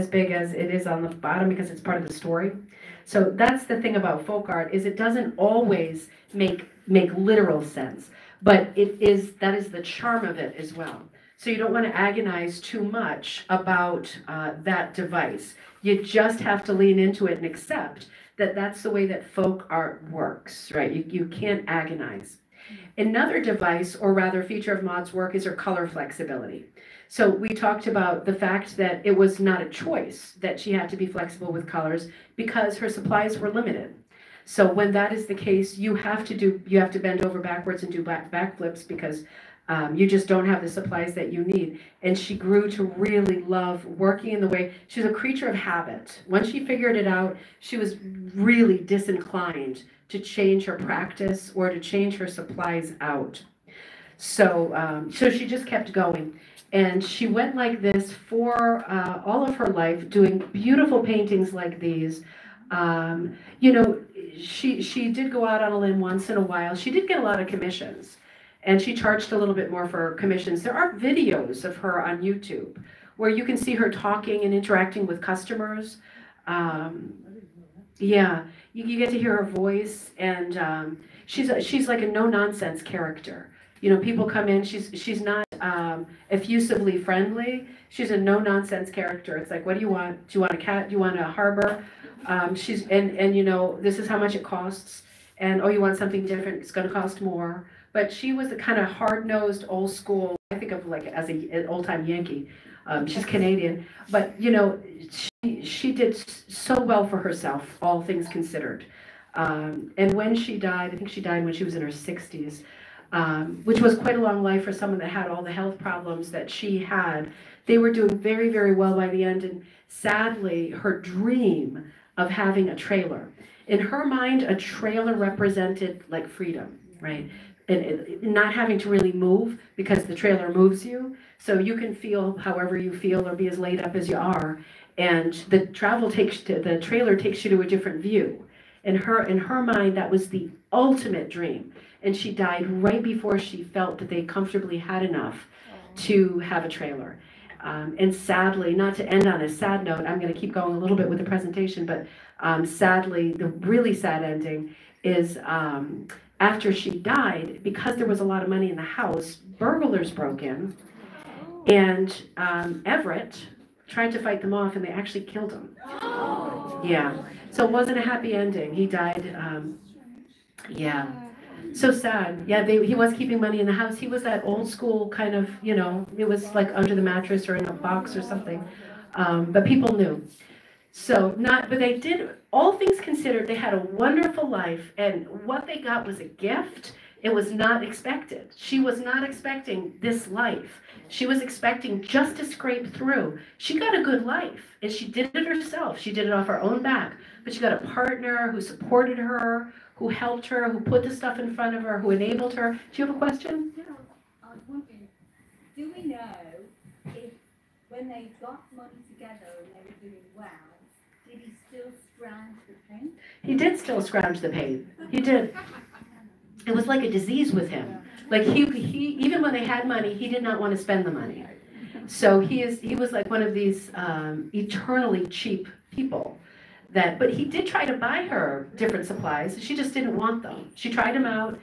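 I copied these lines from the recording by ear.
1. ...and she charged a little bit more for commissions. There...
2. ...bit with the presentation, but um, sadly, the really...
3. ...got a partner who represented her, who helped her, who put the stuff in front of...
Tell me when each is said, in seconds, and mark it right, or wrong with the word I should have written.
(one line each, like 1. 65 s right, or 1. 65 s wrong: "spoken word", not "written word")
1. 68 s right
2. 150 s right
3. 197 s wrong: "supported", not "represented".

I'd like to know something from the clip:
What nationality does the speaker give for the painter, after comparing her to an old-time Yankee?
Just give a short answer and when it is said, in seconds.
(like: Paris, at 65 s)
Canadian, at 103 s.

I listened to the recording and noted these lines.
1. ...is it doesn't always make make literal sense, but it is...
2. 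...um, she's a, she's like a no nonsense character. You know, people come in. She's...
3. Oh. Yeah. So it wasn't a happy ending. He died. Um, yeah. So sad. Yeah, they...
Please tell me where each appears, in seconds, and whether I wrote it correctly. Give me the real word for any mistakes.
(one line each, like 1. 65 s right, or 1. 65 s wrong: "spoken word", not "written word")
1. 4 s right
2. 80 s right
3. 166 s right.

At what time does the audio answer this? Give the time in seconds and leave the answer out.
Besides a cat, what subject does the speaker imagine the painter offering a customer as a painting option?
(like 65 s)
91 s.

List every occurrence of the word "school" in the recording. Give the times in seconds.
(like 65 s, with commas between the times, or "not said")
99 s, 174 s.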